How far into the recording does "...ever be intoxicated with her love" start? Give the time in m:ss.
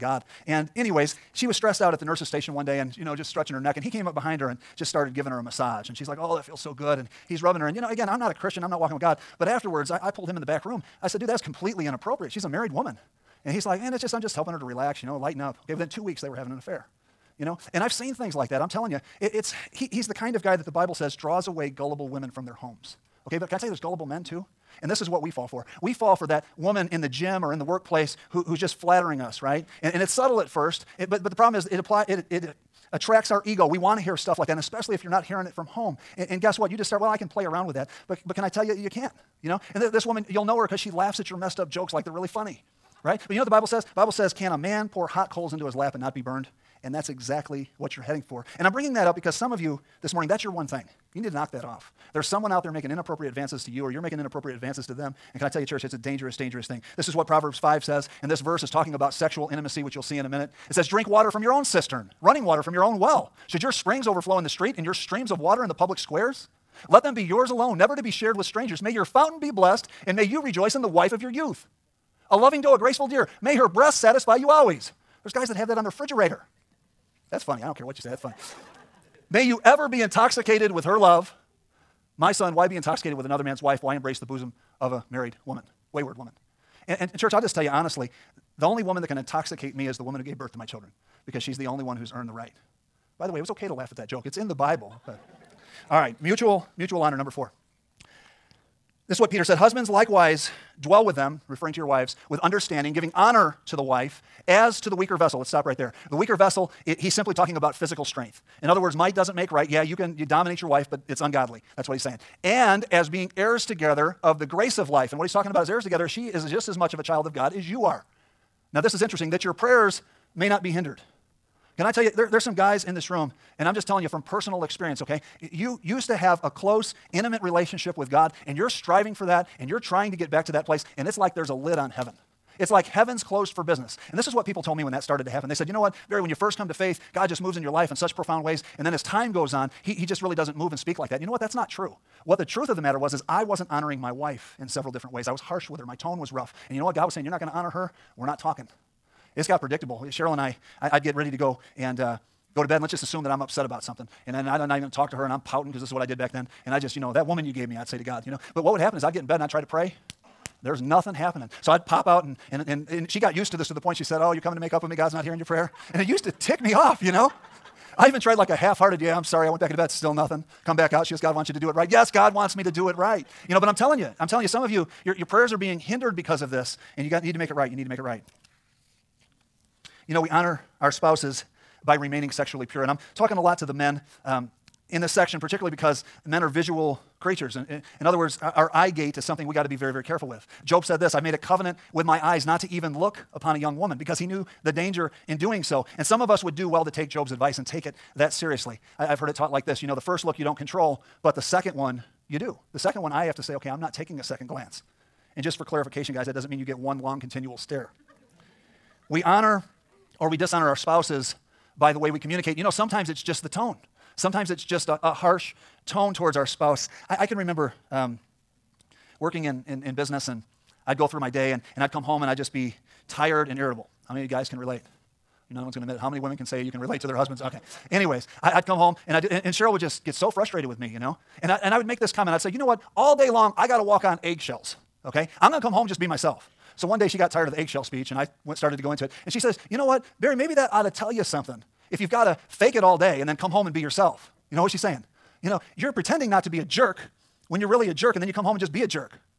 1:19.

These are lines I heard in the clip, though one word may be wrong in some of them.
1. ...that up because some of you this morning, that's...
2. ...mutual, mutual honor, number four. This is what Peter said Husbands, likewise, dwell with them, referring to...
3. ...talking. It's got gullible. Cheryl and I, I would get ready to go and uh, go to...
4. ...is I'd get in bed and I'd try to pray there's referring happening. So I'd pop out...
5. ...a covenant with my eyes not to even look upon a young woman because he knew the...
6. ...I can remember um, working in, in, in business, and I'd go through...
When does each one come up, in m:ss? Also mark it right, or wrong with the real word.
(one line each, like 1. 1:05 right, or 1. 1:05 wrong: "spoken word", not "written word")
1. 0:48 right
2. 1:36 right
3. 2:28 wrong: "predictable", not "gullible"
4. 2:38 wrong: "nothing", not "referring"
5. 3:11 right
6. 3:37 right.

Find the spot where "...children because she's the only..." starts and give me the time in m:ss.
1:30.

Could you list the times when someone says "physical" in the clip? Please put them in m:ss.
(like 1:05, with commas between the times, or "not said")
1:47.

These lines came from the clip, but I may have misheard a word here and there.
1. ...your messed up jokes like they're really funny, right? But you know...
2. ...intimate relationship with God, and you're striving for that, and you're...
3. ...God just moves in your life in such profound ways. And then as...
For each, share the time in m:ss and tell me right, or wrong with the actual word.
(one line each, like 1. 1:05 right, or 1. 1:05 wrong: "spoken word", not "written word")
1. 0:41 right
2. 2:07 right
3. 2:17 right.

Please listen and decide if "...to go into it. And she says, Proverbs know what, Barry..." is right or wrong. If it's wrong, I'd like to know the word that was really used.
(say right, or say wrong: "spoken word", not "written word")
wrong: "You", not "Proverbs".